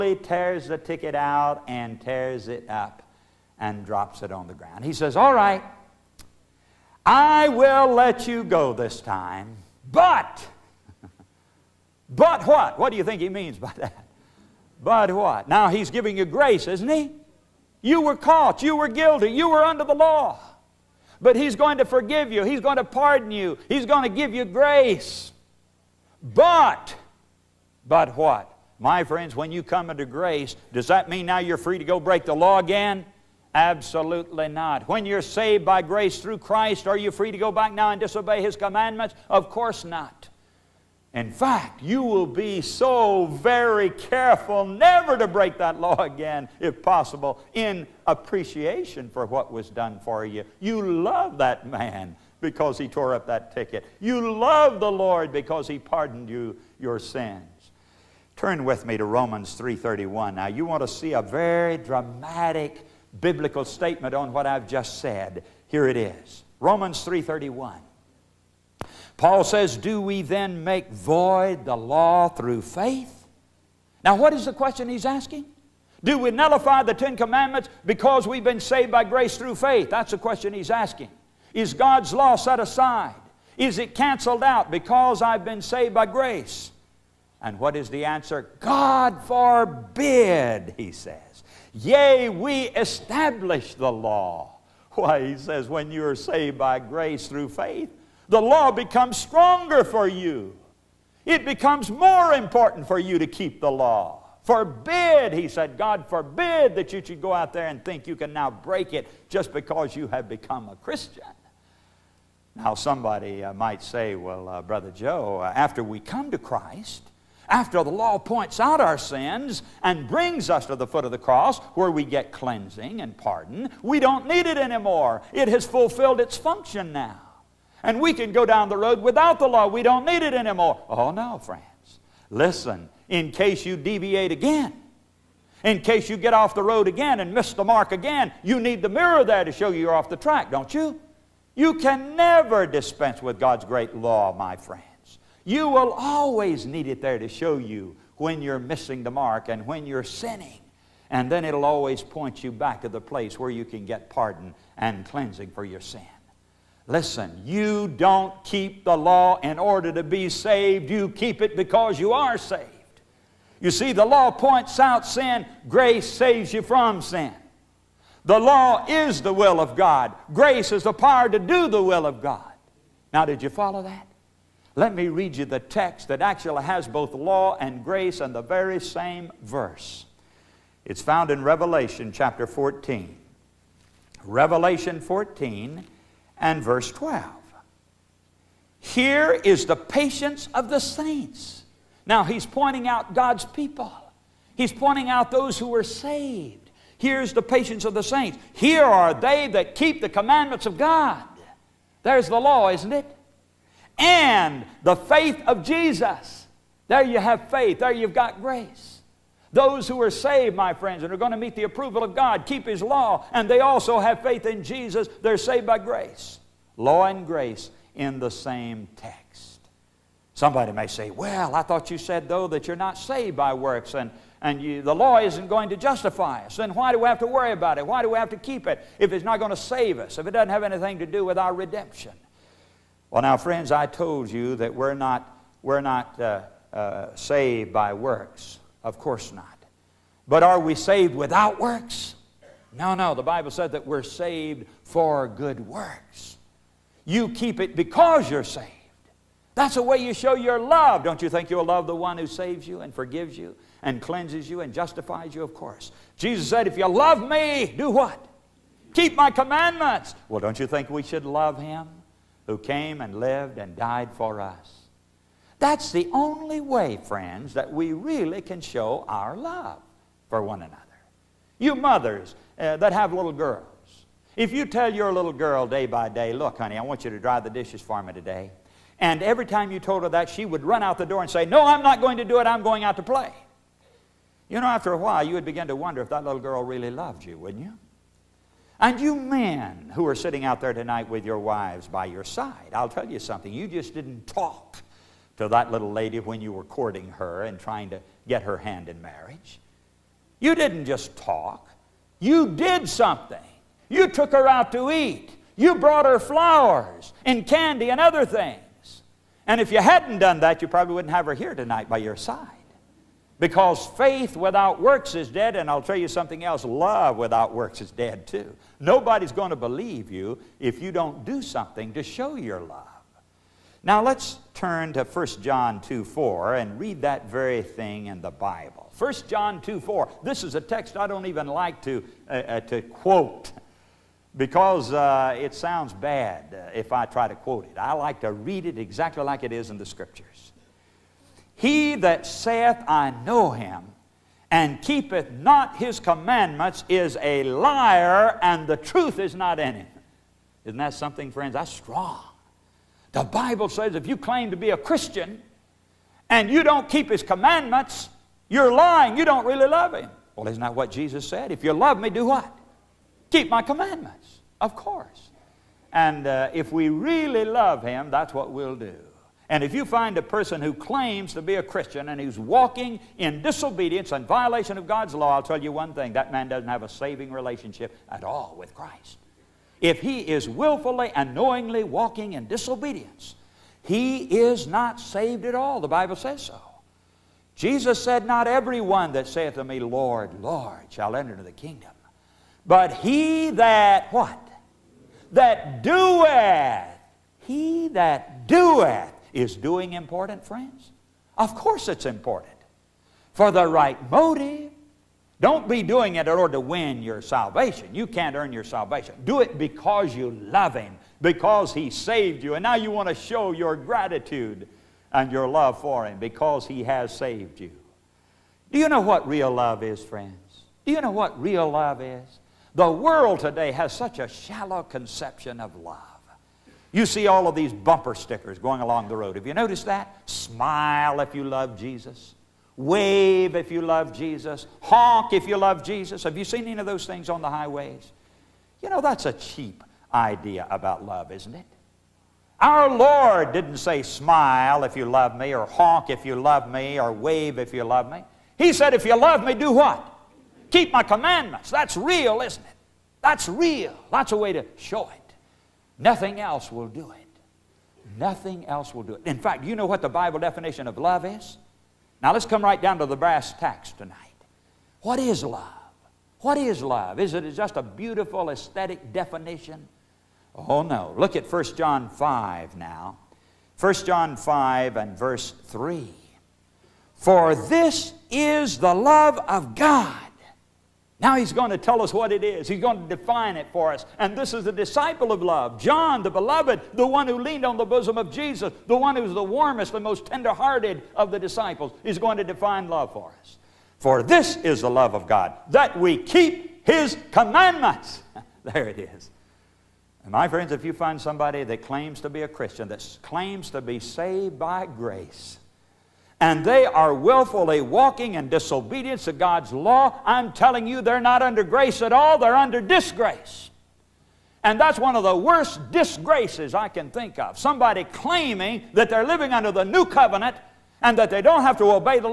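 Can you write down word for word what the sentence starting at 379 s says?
If he is willfully and knowingly walking in disobedience, he is not saved at all.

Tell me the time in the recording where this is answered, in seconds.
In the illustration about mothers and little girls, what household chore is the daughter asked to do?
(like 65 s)
277 s.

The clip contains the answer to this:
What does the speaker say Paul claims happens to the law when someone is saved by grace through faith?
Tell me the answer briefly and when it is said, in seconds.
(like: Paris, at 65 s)
We establish the law, at 92 s.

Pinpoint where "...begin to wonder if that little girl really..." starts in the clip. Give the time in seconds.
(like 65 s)
285 s.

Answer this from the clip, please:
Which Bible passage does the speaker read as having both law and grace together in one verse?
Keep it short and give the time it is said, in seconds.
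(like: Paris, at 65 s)
Revelation 14:12, at 184 s.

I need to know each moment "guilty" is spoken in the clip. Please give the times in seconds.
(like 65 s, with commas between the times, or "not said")
18 s.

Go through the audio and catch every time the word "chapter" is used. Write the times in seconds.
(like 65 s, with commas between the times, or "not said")
182 s.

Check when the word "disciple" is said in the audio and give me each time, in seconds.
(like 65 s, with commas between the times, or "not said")
484 s, 491 s.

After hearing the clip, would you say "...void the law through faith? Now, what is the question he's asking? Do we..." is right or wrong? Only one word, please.
right.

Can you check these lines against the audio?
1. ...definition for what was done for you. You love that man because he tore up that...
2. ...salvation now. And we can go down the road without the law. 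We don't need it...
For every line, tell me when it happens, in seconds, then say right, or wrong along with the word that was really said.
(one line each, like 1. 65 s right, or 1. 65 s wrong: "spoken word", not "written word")
1. 48 s wrong: "appreciation", not "definition"
2. 126 s wrong: "function", not "salvation".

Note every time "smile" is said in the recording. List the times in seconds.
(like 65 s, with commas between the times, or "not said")
430 s, 444 s.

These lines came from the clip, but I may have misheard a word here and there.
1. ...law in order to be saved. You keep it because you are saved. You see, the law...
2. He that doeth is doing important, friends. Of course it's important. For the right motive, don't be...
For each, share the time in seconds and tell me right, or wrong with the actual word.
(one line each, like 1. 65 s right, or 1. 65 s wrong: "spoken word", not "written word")
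1. 158 s right
2. 397 s right.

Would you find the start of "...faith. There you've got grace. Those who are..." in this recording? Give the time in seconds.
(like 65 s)
207 s.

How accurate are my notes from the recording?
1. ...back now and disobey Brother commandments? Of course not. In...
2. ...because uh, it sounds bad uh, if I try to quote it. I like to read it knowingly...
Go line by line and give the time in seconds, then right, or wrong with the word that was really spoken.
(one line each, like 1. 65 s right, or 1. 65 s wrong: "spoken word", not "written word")
1. 37 s wrong: "His", not "Brother"
2. 334 s wrong: "exactly", not "knowingly".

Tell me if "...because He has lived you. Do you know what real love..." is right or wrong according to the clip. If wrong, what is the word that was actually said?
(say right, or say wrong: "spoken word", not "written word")
wrong: "saved", not "lived".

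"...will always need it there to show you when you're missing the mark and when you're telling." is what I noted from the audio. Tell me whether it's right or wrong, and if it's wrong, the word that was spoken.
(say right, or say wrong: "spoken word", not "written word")
wrong: "sinning", not "telling".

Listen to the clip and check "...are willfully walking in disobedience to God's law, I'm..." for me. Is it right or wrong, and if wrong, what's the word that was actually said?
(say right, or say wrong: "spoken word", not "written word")
right.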